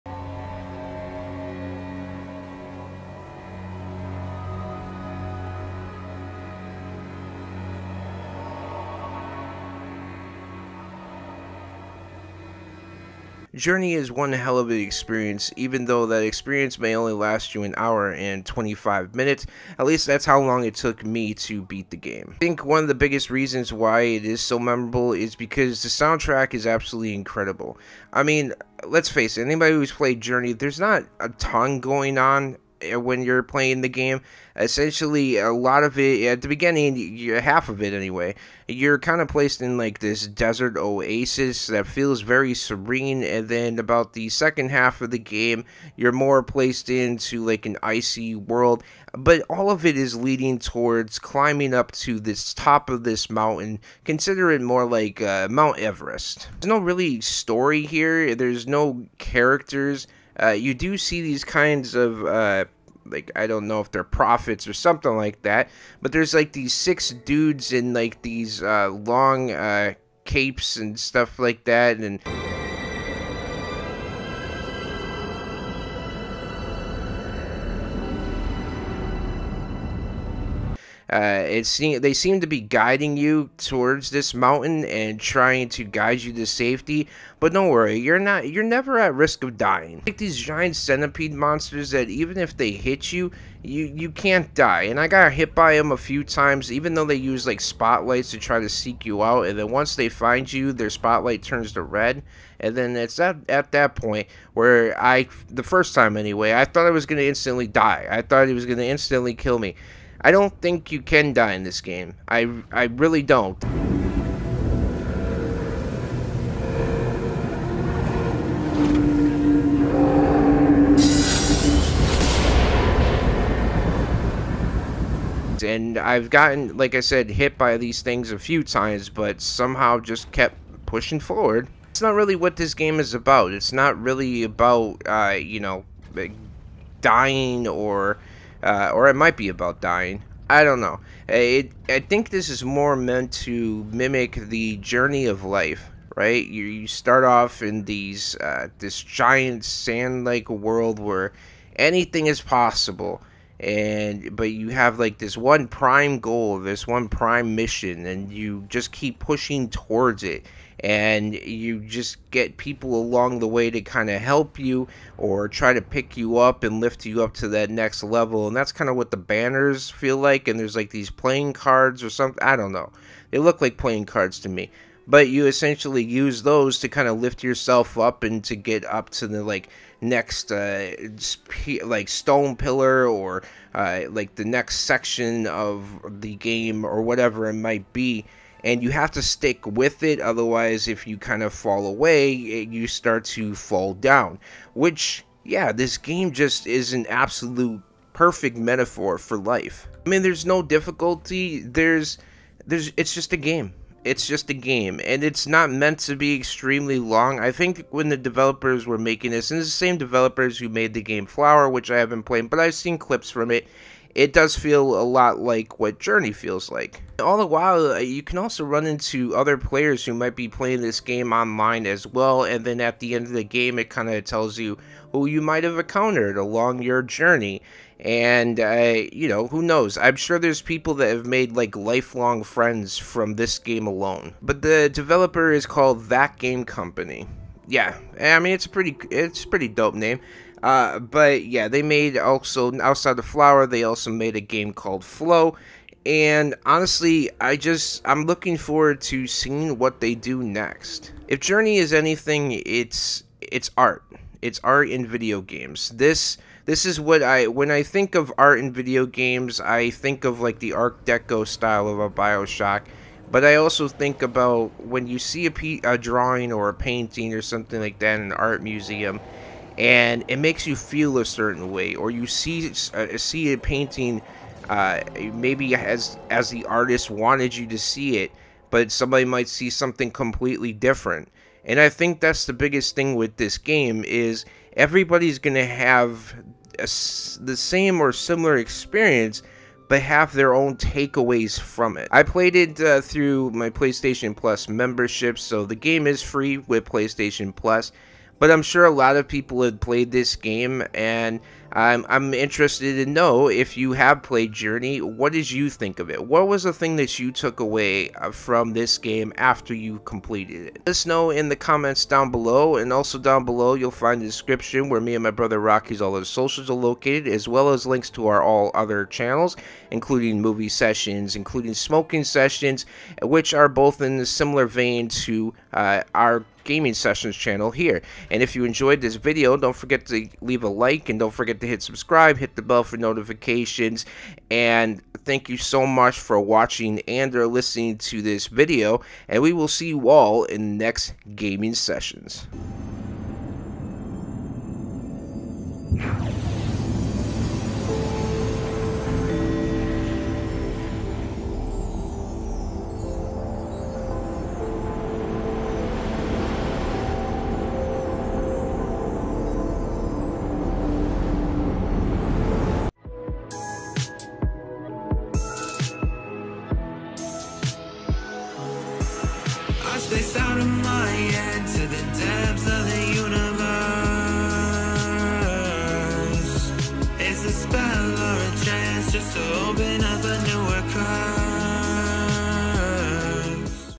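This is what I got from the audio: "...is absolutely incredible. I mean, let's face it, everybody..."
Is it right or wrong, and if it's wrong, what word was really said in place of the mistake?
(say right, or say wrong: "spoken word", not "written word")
wrong: "anybody", not "everybody".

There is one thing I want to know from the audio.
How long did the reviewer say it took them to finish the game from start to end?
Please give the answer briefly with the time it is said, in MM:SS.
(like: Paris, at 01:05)
1 hour 25 minutes, at 00:17.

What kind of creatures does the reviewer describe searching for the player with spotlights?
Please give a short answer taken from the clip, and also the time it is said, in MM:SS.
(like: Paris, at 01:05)
giant centipede monsters, at 01:30.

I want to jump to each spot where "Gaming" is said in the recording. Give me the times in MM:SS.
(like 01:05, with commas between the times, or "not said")
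05:26, 05:41.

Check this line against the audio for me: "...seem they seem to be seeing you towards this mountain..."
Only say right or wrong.
wrong.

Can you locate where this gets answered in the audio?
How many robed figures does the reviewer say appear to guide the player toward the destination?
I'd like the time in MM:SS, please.
01:06.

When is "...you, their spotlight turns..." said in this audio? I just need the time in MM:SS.
01:40.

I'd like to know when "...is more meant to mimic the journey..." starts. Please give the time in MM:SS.
02:22.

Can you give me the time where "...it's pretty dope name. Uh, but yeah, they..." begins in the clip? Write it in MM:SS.
03:59.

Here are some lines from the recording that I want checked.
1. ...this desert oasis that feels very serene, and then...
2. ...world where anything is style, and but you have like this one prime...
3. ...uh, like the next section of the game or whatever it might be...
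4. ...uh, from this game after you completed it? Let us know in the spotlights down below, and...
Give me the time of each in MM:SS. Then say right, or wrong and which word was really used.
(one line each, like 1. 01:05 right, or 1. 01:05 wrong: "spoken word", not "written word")
1. 00:39 right
2. 02:30 wrong: "possible", not "style"
3. 03:03 right
4. 05:08 wrong: "comments", not "spotlights".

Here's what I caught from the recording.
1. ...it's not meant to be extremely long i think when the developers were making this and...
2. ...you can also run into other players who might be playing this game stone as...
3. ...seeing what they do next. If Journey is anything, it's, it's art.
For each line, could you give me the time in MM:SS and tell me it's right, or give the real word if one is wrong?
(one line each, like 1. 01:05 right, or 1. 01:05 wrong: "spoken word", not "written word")
1. 03:25 right
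2. 03:37 wrong: "online", not "stone"
3. 04:09 right.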